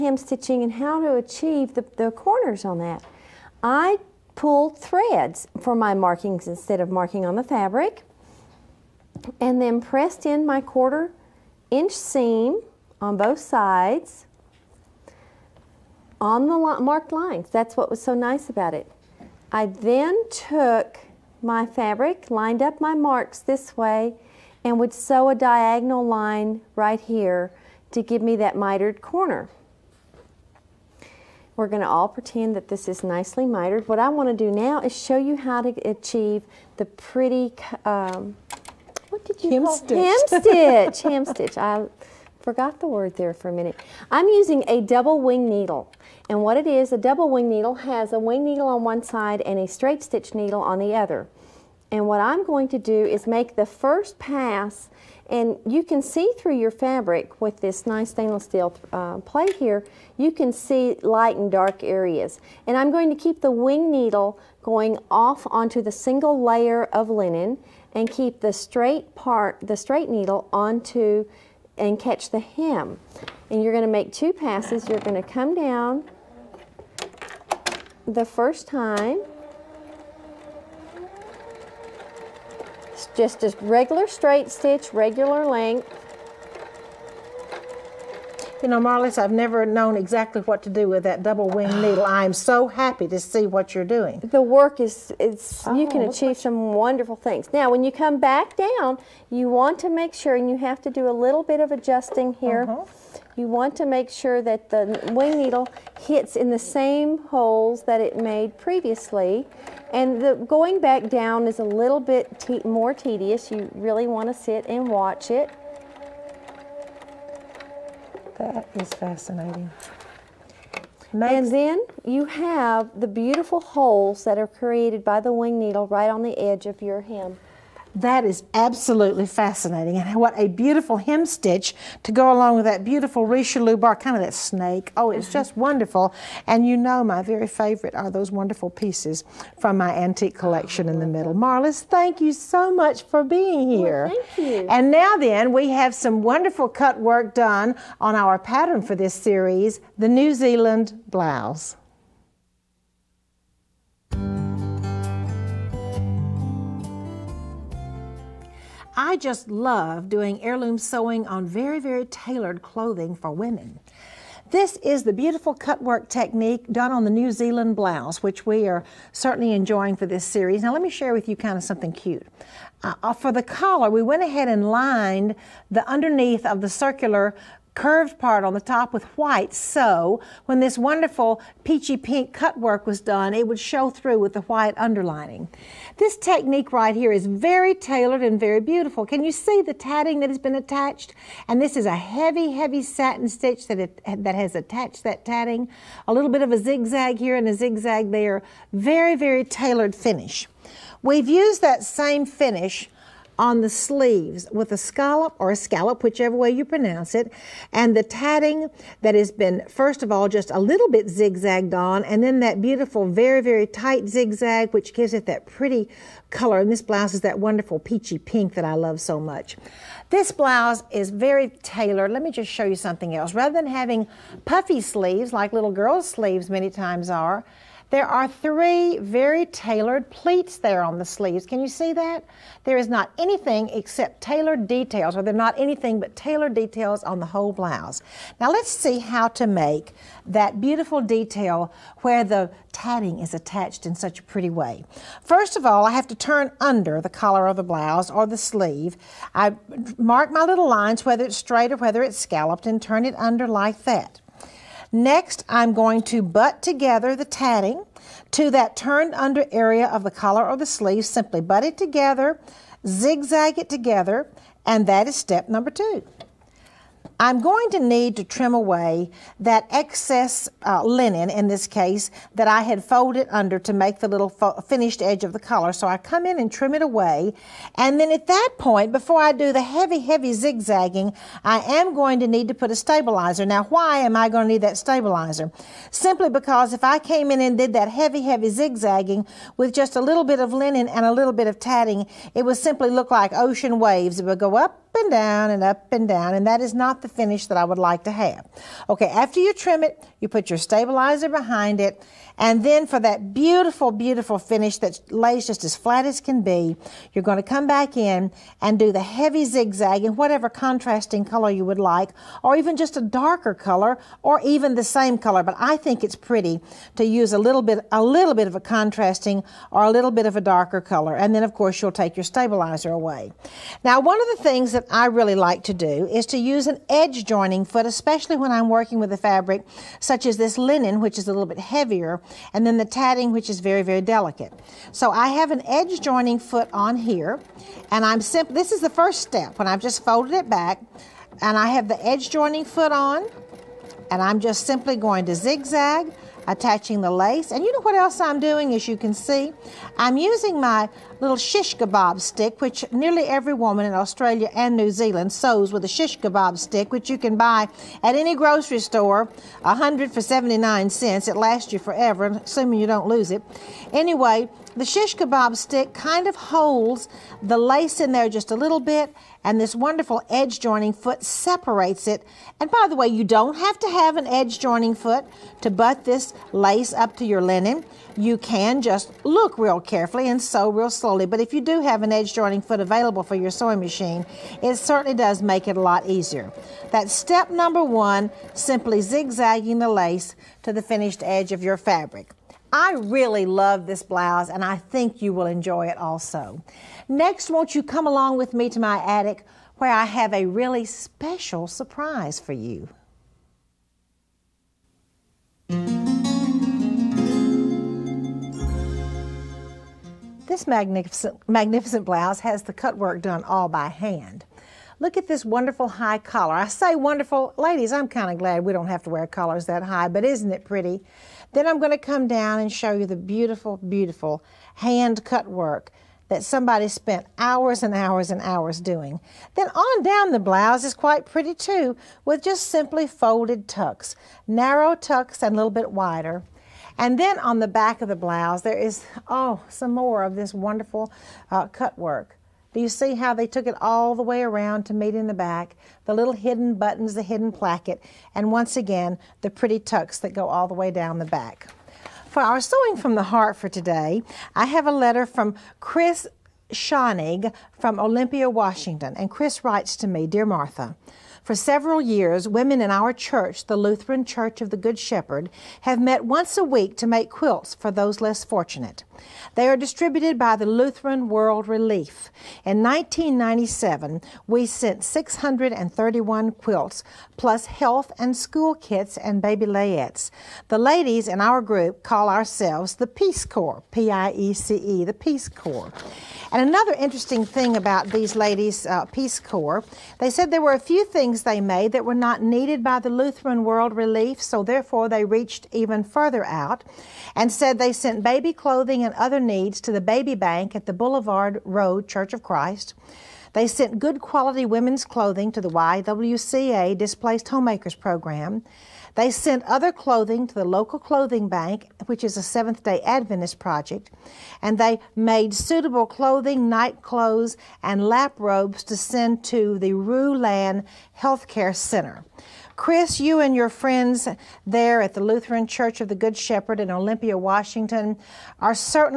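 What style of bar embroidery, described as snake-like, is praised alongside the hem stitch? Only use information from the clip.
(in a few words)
Richelieu bar.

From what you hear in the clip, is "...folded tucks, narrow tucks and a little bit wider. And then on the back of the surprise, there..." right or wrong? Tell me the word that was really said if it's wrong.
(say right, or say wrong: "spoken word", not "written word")
wrong: "blouse", not "surprise".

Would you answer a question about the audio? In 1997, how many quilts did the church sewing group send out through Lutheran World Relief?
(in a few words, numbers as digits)
631.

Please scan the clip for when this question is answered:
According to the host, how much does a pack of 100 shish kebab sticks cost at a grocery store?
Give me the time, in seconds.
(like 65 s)
360 s.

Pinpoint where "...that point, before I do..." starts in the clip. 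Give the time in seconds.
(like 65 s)
278 s.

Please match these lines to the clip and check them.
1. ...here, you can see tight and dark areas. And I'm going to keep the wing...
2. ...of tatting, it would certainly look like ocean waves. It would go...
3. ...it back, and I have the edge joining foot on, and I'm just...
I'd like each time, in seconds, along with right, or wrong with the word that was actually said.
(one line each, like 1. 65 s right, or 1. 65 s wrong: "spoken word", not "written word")
1. 59 s wrong: "light", not "tight"
2. 291 s wrong: "simply", not "certainly"
3. 340 s right.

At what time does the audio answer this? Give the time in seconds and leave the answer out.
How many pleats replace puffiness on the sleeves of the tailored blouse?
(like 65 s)
228 s.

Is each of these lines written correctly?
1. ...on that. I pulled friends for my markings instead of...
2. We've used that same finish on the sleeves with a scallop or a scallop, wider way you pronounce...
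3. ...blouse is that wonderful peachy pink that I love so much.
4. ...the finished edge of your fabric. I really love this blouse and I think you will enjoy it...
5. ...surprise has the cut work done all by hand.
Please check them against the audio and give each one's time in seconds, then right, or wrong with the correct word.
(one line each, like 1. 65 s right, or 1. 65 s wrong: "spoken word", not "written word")
1. 2 s wrong: "threads", not "friends"
2. 201 s wrong: "whichever", not "wider"
3. 216 s right
4. 390 s right
5. 412 s wrong: "blouse", not "surprise".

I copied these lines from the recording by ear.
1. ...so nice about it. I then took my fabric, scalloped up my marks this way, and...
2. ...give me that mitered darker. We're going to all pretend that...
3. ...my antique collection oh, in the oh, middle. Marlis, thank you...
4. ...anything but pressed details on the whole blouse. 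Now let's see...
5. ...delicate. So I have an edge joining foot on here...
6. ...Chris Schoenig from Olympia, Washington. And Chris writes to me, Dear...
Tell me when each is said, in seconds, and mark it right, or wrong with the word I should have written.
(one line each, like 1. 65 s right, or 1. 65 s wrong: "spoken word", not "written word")
1. 18 s wrong: "lined", not "scalloped"
2. 28 s wrong: "corner", not "darker"
3. 139 s right
4. 235 s wrong: "tailored", not "pressed"
5. 334 s right
6. 455 s right.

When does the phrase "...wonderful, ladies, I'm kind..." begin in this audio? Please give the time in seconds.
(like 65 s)
416 s.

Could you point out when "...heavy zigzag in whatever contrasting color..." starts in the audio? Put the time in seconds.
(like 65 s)
309 s.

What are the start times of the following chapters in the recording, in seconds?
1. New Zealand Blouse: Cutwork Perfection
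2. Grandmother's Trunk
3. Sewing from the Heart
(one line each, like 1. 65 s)
1. 153 s
2. 404 s
3. 450 s.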